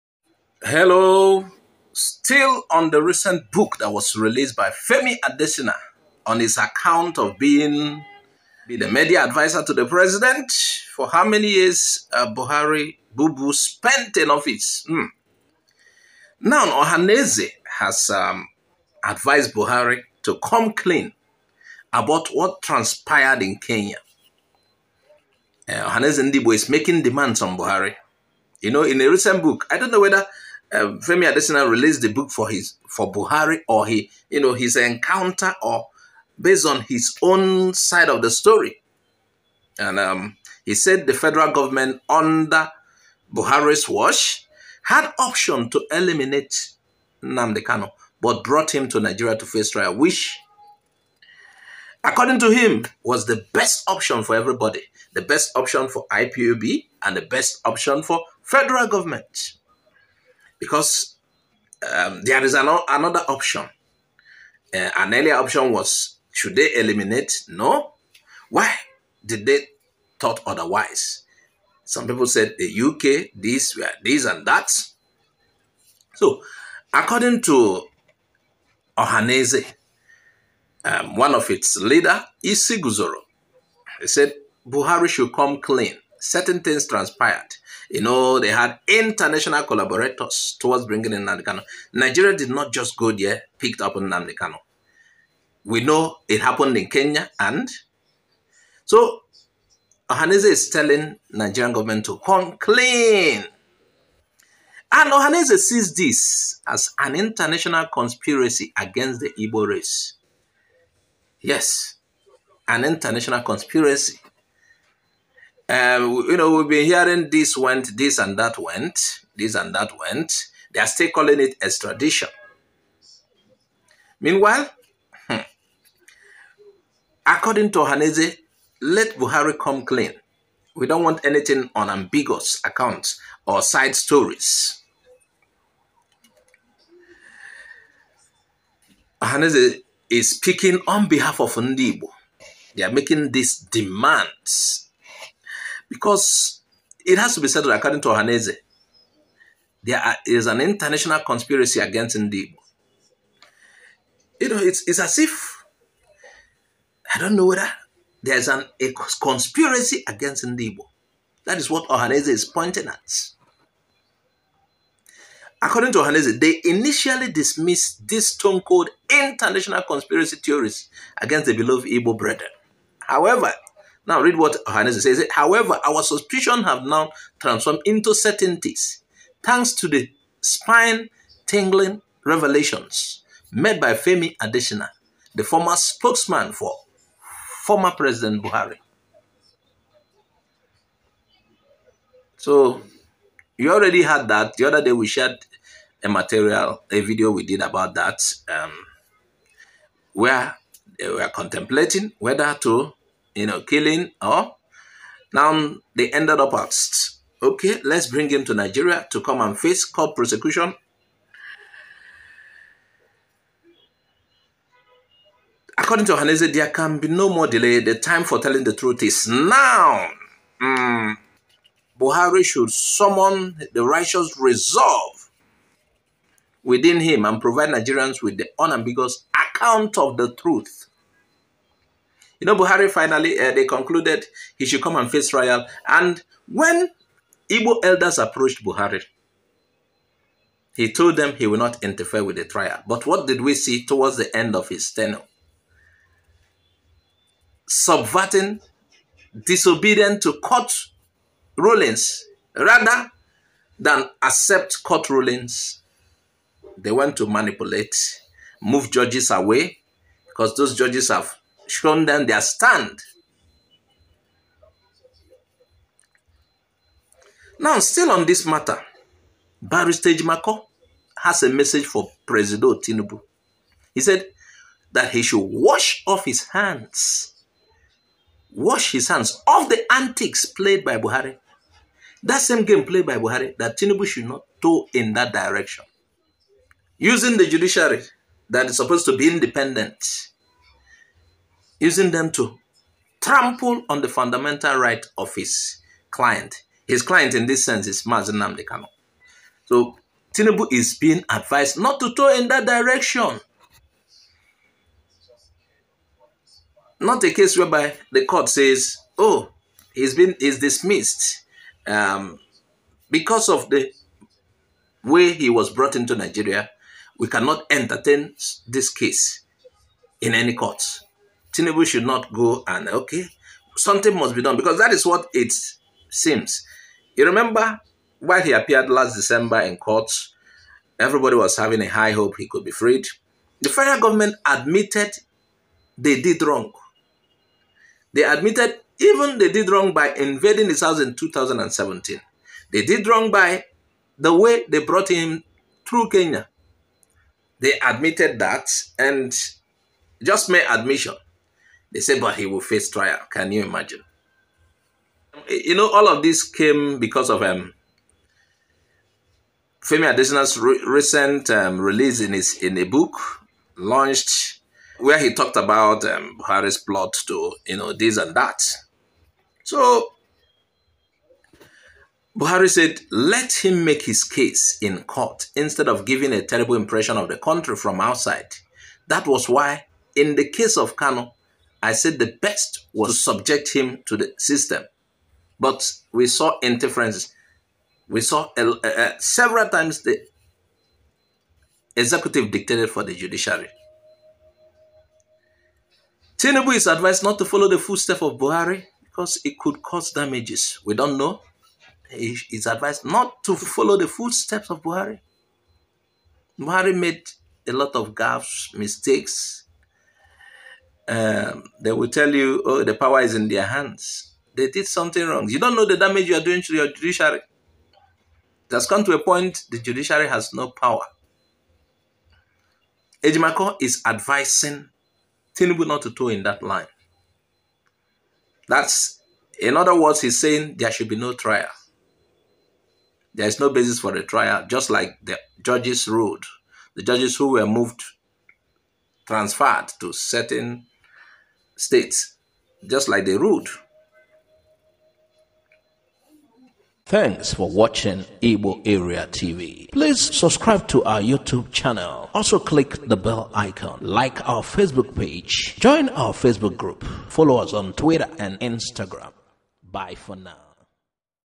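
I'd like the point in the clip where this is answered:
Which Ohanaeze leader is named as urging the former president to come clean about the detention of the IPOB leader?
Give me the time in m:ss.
1:22.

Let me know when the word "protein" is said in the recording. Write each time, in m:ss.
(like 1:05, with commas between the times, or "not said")
not said.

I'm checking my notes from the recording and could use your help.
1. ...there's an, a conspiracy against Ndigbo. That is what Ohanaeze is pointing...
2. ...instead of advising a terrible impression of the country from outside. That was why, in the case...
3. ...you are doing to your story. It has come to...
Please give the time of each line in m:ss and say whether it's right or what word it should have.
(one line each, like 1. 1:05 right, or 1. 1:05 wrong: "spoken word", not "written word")
1. 2:38 right
2. 6:15 wrong: "giving", not "advising"
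3. 6:56 wrong: "judiciary", not "story".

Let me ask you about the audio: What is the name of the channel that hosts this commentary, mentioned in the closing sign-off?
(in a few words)
Igbo Area TV.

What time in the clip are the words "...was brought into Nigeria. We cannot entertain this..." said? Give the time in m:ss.
5:15.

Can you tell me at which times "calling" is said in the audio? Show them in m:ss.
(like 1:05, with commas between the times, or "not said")
2:01.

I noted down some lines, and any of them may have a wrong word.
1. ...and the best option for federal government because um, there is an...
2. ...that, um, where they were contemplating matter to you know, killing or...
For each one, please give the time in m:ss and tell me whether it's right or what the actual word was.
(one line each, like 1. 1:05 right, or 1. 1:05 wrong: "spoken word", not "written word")
1. 0:57 right
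2. 3:17 wrong: "whether", not "matter".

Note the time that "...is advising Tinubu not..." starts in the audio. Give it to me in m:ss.
7:03.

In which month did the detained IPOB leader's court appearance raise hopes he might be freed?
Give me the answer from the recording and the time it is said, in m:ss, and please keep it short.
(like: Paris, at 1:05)
December, at 5:29.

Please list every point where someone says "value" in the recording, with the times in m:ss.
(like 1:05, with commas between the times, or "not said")
not said.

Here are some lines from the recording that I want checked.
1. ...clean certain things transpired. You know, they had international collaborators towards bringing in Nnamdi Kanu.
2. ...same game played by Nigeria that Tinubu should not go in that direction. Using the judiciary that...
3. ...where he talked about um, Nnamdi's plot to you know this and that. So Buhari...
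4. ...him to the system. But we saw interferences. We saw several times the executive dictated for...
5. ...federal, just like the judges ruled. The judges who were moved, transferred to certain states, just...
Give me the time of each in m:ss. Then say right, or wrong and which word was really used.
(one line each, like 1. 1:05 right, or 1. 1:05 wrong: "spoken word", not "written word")
1. 1:25 right
2. 4:42 wrong: "Buhari", not "Nigeria"
3. 6:04 wrong: "Buhari", not "Nnamdi"
4. 6:23 right
5. 7:14 wrong: "trial", not "federal".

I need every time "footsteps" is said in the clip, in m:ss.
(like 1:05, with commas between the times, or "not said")
6:37, 6:44.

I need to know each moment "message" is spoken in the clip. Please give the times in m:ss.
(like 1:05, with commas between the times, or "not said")
4:31.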